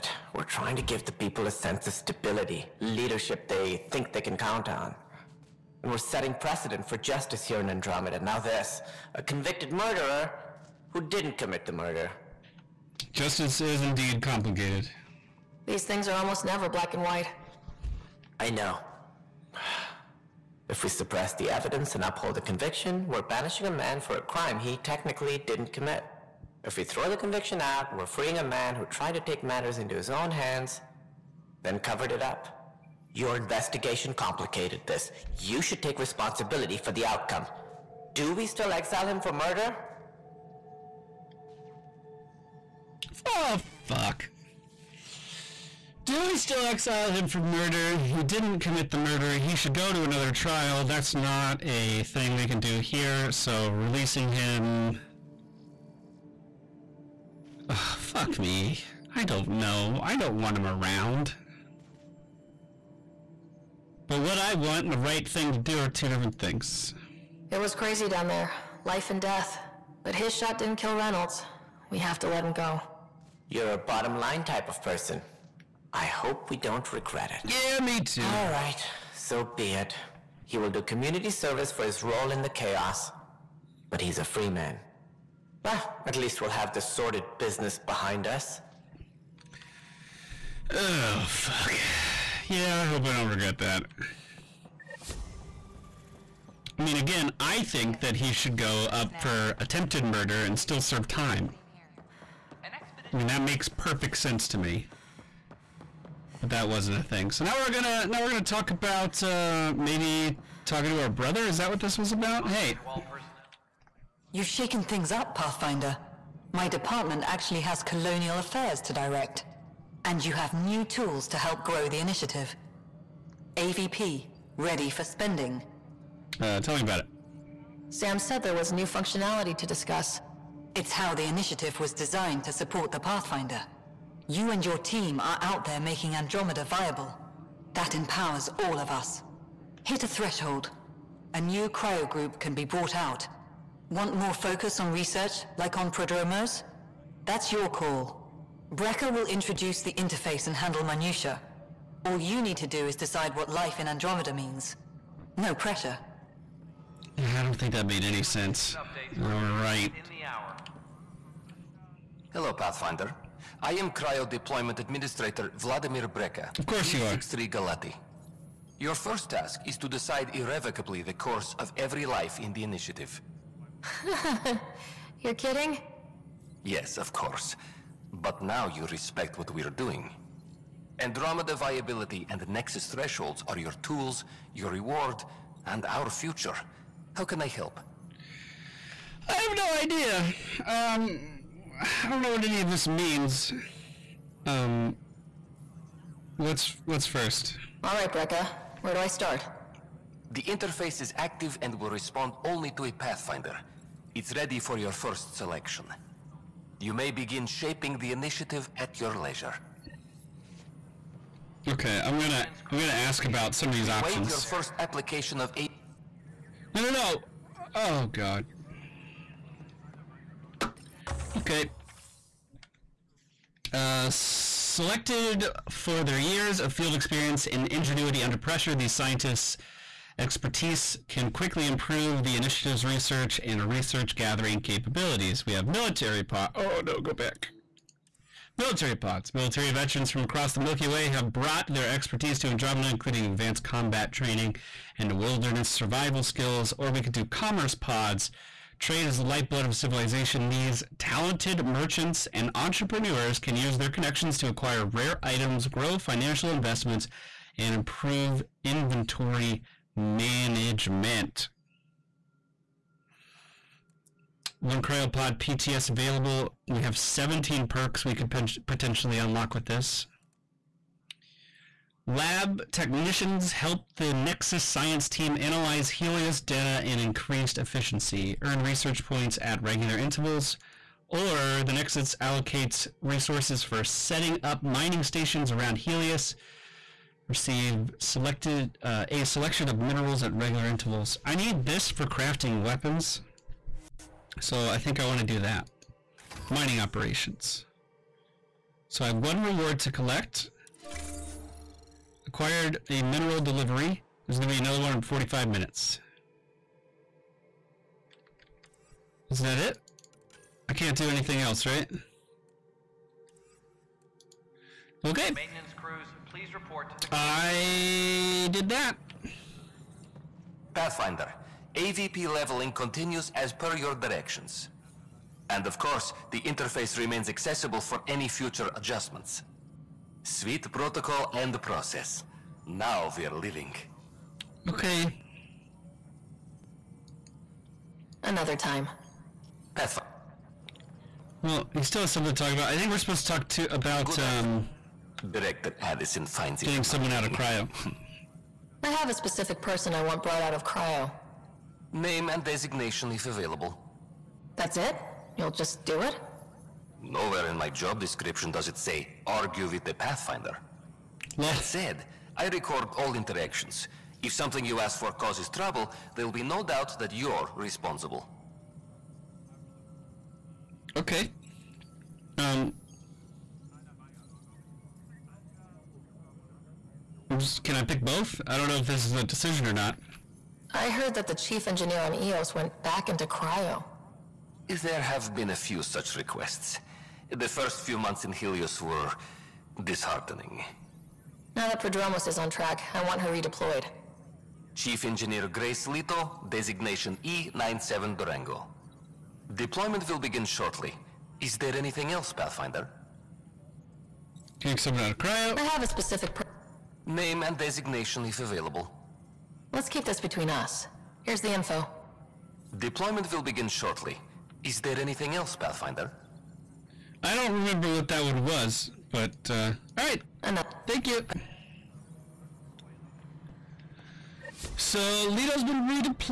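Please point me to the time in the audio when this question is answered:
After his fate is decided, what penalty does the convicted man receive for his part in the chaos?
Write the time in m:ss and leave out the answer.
1:20.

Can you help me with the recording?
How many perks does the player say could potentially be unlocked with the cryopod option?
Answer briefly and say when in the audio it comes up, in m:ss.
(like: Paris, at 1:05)
17, at 4:26.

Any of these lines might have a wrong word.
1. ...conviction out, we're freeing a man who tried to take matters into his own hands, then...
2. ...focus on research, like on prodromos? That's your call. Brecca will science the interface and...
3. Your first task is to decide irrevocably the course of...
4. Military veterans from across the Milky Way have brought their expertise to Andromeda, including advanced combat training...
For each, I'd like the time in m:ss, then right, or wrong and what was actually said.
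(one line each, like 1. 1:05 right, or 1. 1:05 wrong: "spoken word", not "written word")
1. 0:27 right
2. 2:24 wrong: "introduce", not "science"
3. 2:48 right
4. 3:59 right.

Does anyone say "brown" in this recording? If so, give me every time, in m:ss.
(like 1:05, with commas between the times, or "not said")
not said.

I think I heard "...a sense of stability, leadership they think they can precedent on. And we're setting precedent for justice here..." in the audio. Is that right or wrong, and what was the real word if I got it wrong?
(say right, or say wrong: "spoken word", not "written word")
wrong: "count", not "precedent".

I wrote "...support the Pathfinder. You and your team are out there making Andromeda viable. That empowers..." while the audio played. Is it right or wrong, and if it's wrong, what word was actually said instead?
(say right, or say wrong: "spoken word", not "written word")
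right.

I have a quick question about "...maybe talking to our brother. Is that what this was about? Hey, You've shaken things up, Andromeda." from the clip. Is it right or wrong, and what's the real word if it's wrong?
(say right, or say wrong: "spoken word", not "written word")
wrong: "Pathfinder", not "Andromeda".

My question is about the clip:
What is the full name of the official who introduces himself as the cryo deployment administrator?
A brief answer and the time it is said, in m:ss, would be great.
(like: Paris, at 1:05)
Vladimir Brecca, at 2:45.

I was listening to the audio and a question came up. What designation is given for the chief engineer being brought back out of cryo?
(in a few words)
E97 Durango.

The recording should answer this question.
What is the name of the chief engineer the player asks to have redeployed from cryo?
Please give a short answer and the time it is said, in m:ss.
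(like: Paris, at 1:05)
Grace Leto, at 6:35.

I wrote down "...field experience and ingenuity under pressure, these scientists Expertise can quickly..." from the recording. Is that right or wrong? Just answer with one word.
right.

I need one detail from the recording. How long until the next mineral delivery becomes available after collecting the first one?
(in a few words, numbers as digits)
45 minutes.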